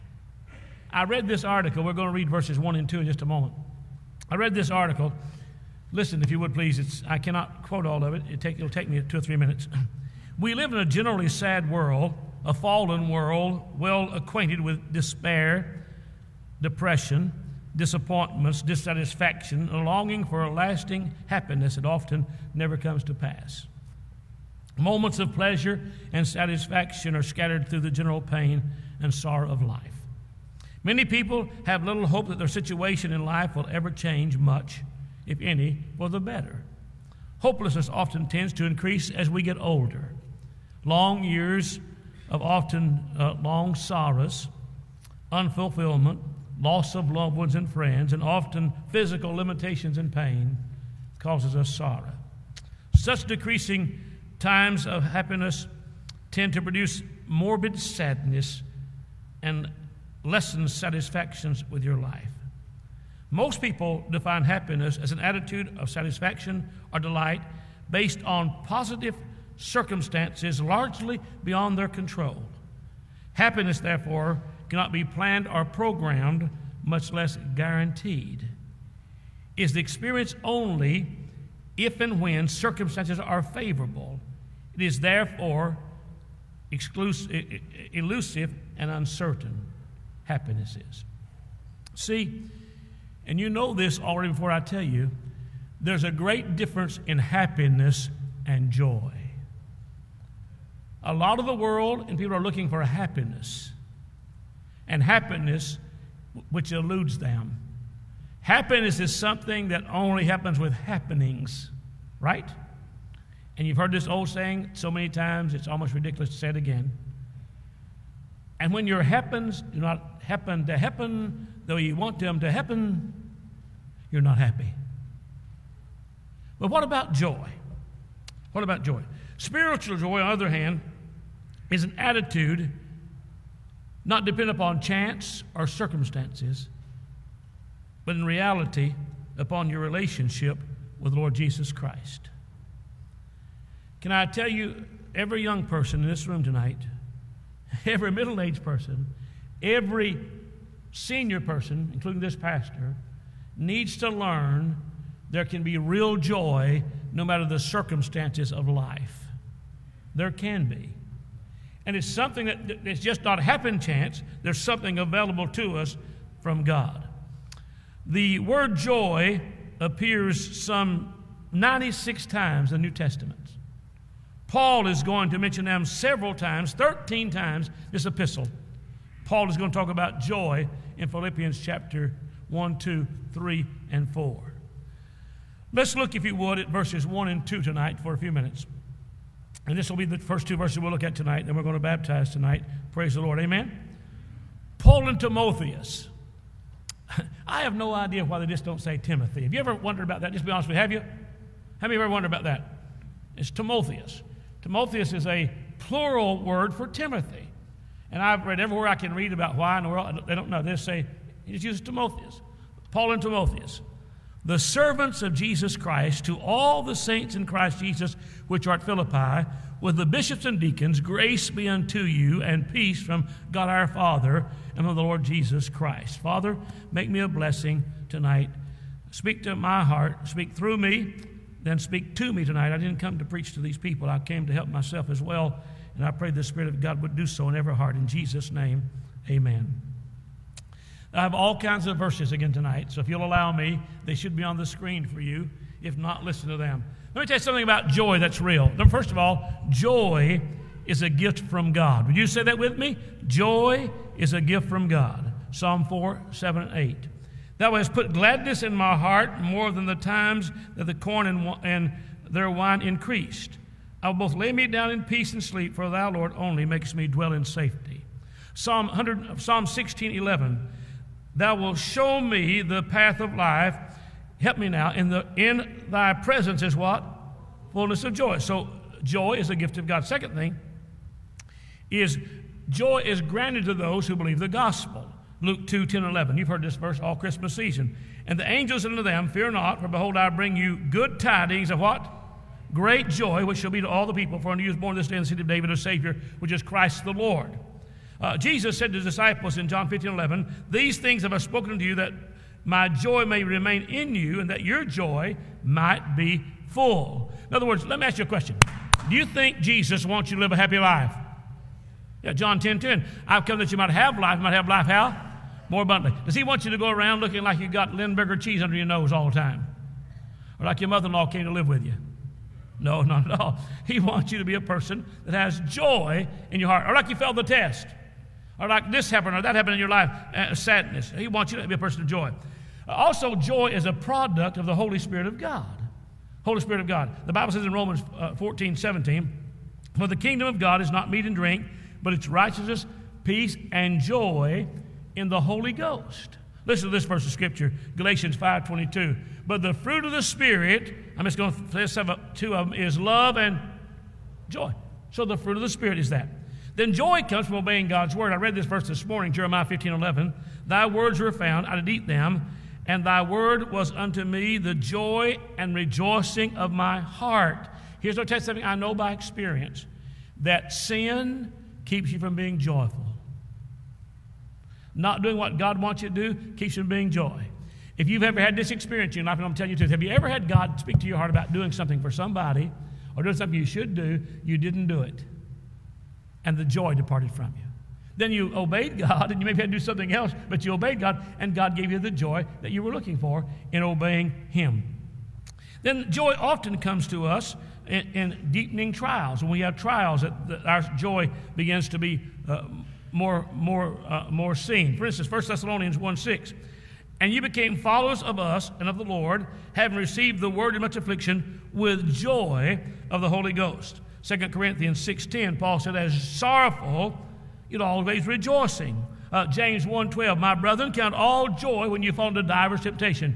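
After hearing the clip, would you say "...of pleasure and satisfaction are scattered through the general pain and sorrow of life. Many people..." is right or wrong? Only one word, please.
right.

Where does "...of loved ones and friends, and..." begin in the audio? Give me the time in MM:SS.
00:46.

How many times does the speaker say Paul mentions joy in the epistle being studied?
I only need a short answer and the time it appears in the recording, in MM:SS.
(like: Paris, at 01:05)
13, at 02:56.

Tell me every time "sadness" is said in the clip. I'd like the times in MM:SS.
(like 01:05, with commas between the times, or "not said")
00:57, 05:30.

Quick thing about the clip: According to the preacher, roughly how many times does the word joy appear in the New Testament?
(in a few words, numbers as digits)
96.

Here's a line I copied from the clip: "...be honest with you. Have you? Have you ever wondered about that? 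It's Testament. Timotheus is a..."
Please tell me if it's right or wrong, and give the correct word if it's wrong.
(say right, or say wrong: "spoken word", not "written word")
wrong: "Timotheus", not "Testament".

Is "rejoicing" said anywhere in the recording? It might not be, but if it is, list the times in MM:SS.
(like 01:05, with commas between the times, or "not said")
06:05, 06:58.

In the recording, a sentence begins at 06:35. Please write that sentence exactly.
Then joy often comes to us in, in deepening trials.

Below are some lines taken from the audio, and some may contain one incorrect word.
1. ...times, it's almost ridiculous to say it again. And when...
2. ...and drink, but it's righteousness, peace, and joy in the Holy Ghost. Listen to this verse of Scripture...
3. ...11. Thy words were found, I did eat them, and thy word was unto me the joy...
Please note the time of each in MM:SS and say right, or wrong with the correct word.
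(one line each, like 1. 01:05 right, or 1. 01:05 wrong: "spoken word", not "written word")
1. 01:55 right
2. 05:41 right
3. 05:59 right.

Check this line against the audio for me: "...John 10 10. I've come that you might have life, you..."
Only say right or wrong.
right.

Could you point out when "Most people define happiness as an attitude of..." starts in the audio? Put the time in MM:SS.
01:03.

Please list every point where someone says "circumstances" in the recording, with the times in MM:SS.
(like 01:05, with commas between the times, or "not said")
01:09, 01:22, 02:15, 02:37.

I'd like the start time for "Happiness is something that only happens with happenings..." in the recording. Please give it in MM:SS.
01:48.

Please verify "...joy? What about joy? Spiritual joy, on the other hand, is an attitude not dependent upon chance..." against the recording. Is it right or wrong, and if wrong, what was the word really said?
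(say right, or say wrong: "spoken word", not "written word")
right.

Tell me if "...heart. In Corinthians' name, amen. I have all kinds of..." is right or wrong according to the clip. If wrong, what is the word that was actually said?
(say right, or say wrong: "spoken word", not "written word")
wrong: "Jesus", not "Corinthians".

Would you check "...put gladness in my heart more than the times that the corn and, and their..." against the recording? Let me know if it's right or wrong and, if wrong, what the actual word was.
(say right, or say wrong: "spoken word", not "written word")
right.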